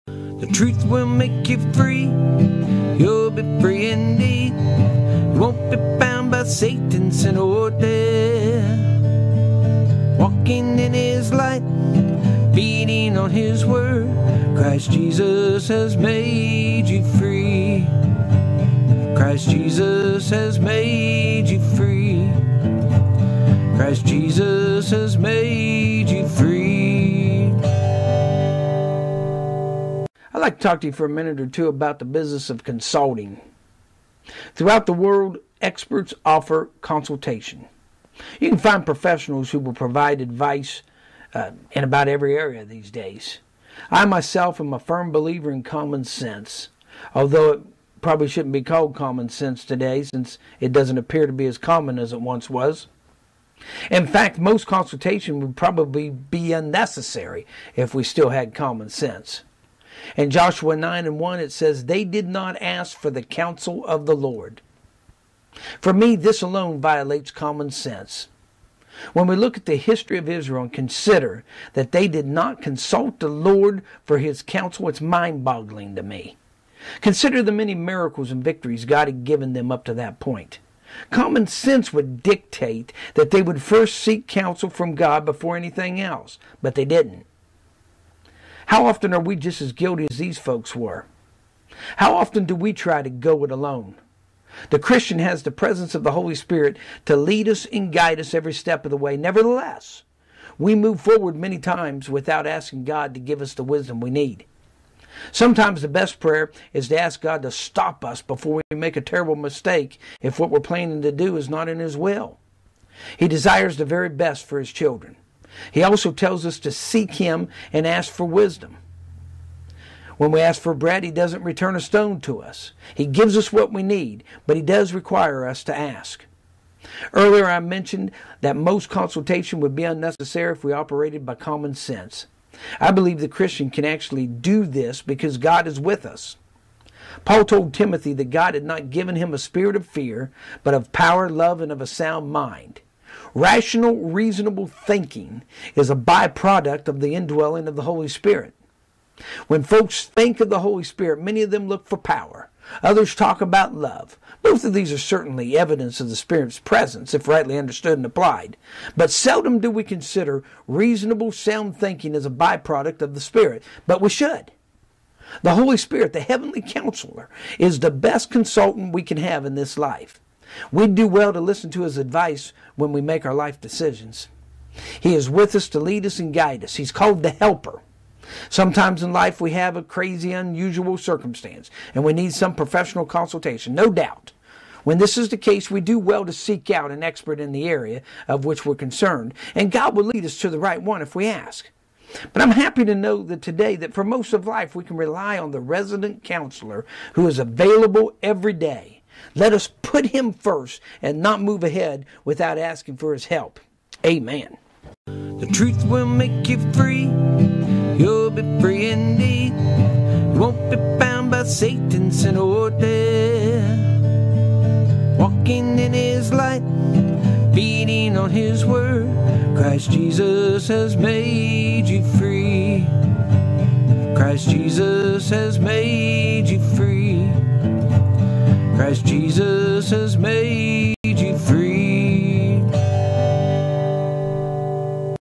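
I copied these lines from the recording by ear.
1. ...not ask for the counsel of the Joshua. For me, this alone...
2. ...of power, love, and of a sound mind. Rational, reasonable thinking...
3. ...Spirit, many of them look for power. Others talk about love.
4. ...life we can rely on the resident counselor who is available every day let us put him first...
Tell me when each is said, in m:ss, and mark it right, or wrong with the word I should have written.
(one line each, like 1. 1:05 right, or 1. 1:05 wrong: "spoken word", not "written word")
1. 1:02 wrong: "Lord", not "Joshua"
2. 2:20 right
3. 2:30 right
4. 3:14 right.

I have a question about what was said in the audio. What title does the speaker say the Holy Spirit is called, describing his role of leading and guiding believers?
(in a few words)
The helper.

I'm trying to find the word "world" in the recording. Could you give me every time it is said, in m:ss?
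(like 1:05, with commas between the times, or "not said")
0:34.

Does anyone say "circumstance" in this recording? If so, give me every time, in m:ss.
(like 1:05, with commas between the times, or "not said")
3:00.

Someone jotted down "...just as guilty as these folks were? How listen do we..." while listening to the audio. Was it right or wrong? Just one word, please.
wrong.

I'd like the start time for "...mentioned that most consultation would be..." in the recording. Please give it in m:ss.
2:07.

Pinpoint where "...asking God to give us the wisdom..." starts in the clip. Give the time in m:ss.
1:42.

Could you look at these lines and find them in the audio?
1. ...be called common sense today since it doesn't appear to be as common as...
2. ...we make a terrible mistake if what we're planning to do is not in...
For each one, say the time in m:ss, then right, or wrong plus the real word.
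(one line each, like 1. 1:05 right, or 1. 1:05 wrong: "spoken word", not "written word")
1. 0:48 right
2. 1:48 right.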